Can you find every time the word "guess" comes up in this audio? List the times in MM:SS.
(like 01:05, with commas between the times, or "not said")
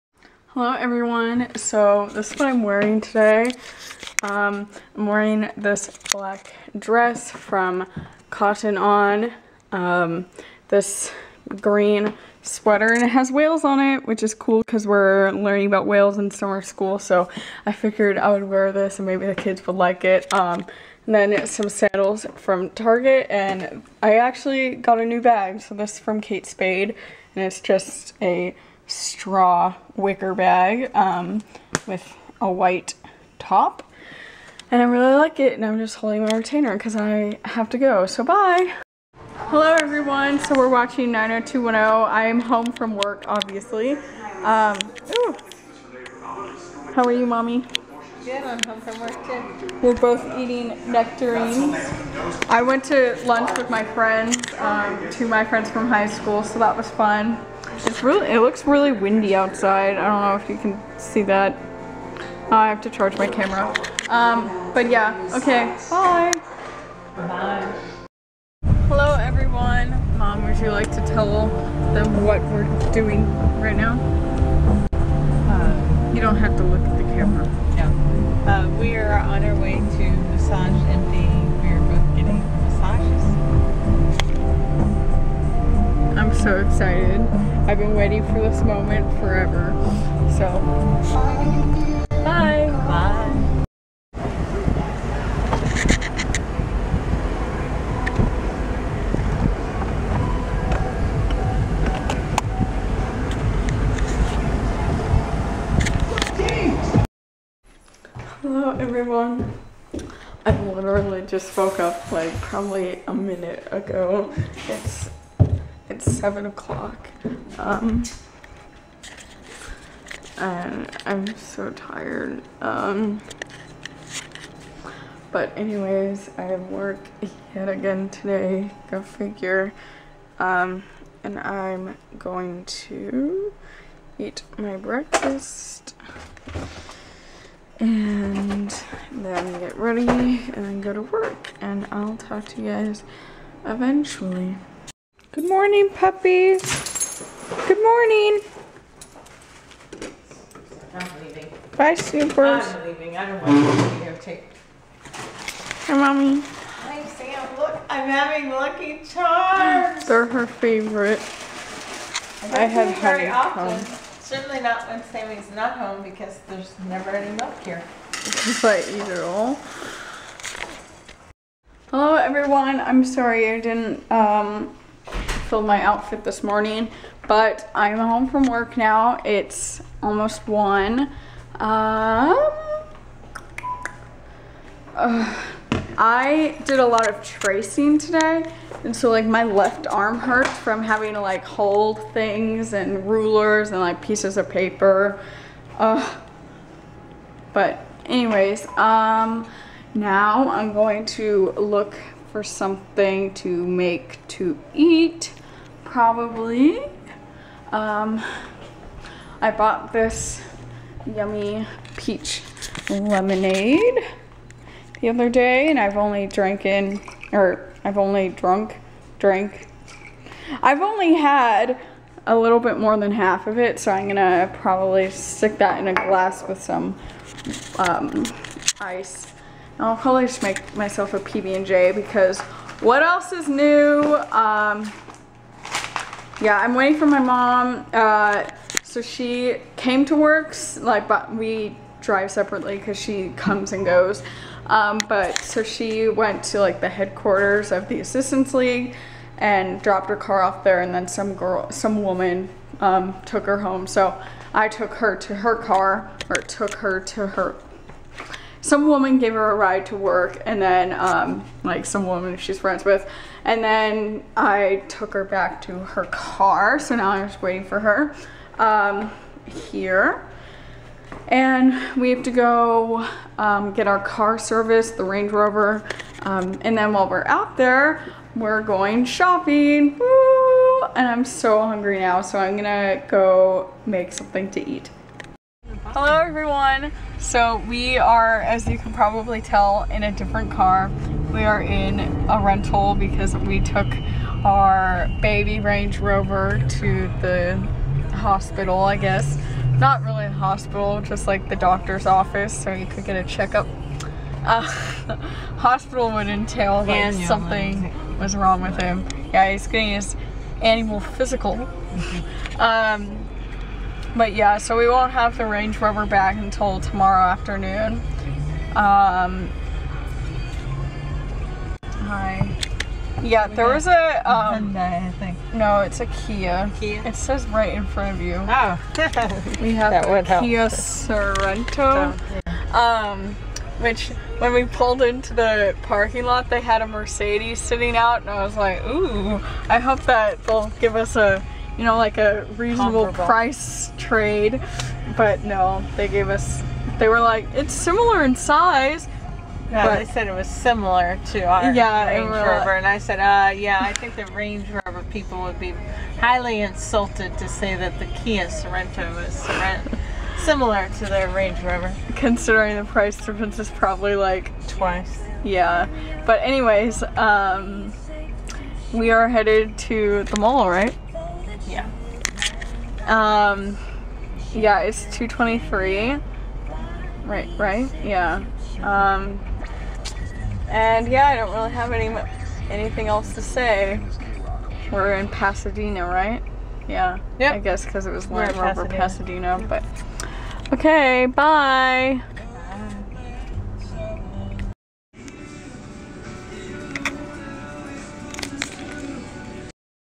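04:58, 06:27.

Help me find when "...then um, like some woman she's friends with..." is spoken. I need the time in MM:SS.
04:20.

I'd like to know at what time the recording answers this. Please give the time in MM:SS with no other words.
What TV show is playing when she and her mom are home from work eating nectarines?
00:41.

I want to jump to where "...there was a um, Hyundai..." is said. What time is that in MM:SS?
05:23.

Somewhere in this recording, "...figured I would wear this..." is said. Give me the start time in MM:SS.
00:17.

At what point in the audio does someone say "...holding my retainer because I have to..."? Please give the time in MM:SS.
00:35.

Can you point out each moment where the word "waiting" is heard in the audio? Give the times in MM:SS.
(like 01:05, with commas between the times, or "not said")
01:27, 03:56, 04:27.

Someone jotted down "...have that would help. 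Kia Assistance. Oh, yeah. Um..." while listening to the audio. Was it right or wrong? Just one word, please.
wrong.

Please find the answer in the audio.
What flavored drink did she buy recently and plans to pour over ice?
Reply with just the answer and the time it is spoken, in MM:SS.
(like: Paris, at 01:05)
Peach lemonade, at 03:31.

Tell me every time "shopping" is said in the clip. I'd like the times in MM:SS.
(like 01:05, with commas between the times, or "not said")
04:39.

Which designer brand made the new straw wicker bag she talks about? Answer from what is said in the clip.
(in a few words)
Kate Spade.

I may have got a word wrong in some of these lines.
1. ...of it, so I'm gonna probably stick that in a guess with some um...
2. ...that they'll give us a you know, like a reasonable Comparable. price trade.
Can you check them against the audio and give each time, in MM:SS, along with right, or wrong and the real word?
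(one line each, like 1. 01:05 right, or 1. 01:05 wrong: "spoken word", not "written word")
1. 03:43 wrong: "glass", not "guess"
2. 05:40 right.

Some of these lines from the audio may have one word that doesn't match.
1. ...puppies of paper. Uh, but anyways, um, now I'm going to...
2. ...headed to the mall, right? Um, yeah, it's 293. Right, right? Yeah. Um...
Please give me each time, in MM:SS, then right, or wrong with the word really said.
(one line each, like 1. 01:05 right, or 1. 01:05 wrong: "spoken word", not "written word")
1. 03:14 wrong: "pieces", not "puppies"
2. 06:09 wrong: "223", not "293".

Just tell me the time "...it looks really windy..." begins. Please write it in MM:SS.
00:58.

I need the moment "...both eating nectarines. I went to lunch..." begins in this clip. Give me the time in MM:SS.
00:49.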